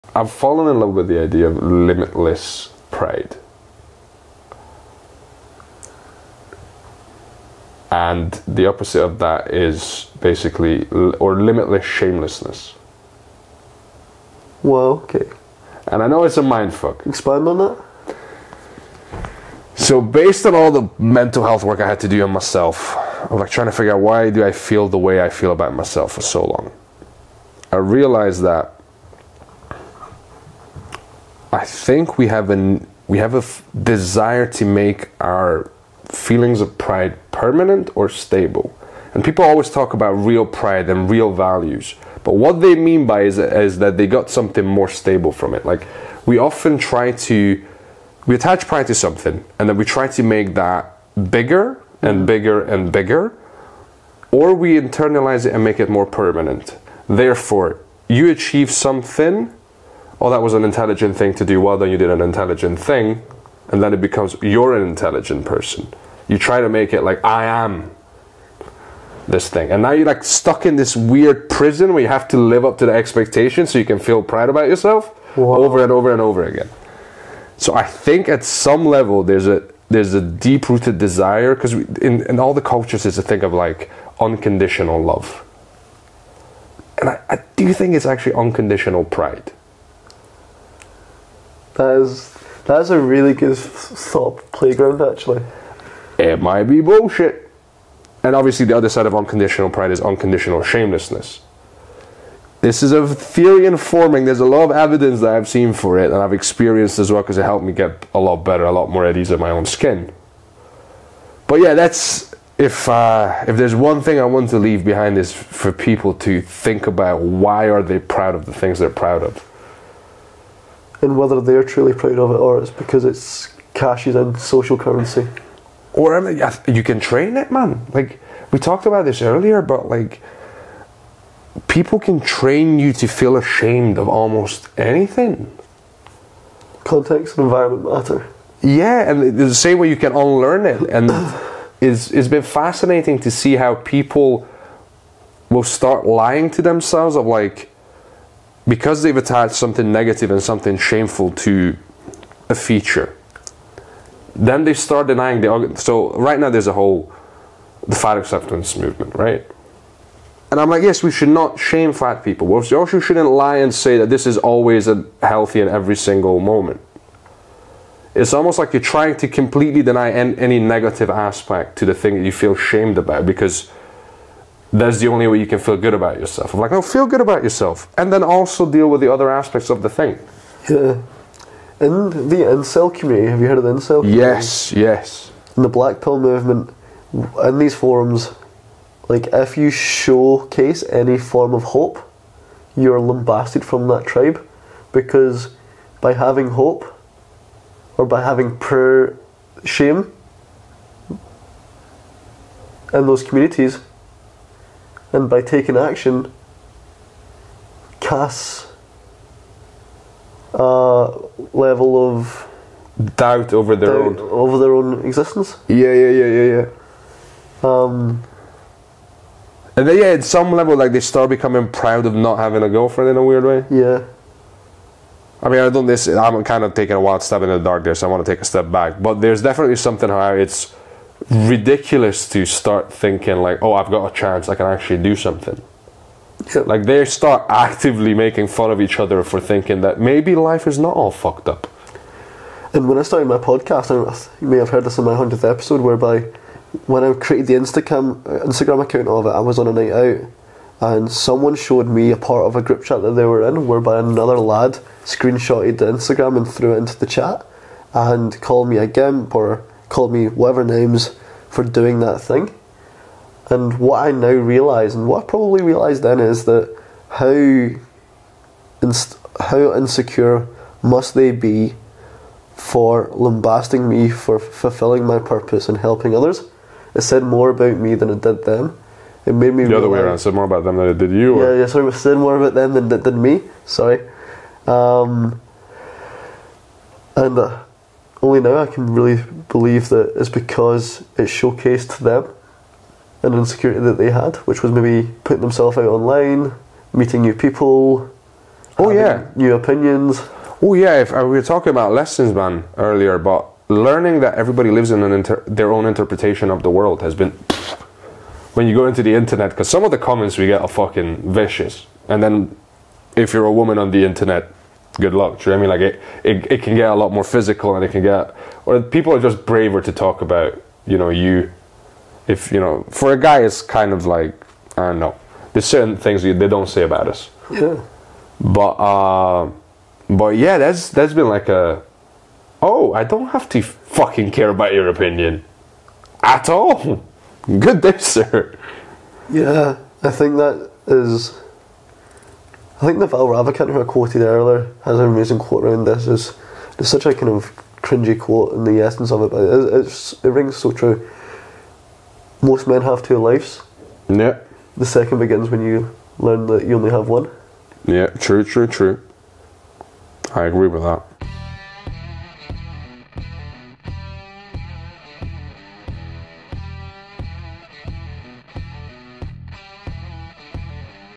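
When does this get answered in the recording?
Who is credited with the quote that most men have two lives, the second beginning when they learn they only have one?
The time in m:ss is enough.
5:42.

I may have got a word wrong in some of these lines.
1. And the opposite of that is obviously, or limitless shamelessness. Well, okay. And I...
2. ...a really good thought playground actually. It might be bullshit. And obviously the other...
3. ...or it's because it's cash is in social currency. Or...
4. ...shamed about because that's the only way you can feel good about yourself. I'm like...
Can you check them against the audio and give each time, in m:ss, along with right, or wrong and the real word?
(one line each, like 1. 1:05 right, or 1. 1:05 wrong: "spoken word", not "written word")
1. 0:07 wrong: "basically", not "obviously"
2. 1:32 right
3. 2:02 right
4. 2:52 right.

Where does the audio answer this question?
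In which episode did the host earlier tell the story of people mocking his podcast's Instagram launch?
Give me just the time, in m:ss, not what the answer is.
4:05.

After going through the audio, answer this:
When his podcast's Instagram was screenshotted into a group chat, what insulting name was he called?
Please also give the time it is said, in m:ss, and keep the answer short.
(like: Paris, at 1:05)
gimp, at 4:18.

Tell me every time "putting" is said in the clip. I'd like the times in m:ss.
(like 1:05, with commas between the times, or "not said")
4:55.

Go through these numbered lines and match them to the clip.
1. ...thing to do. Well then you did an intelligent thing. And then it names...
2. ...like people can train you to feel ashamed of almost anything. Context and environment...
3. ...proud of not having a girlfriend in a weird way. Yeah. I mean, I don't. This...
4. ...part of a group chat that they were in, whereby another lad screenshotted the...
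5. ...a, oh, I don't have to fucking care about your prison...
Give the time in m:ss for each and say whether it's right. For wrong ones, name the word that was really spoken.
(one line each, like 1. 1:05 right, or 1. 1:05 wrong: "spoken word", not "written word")
1. 1:01 wrong: "becomes", not "names"
2. 2:09 right
3. 3:41 right
4. 4:12 right
5. 5:31 wrong: "opinion", not "prison".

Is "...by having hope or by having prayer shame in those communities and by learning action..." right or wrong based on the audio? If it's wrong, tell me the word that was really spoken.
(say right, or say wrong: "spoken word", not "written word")
wrong: "taking", not "learning".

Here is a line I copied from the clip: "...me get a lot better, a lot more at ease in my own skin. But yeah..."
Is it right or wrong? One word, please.
right.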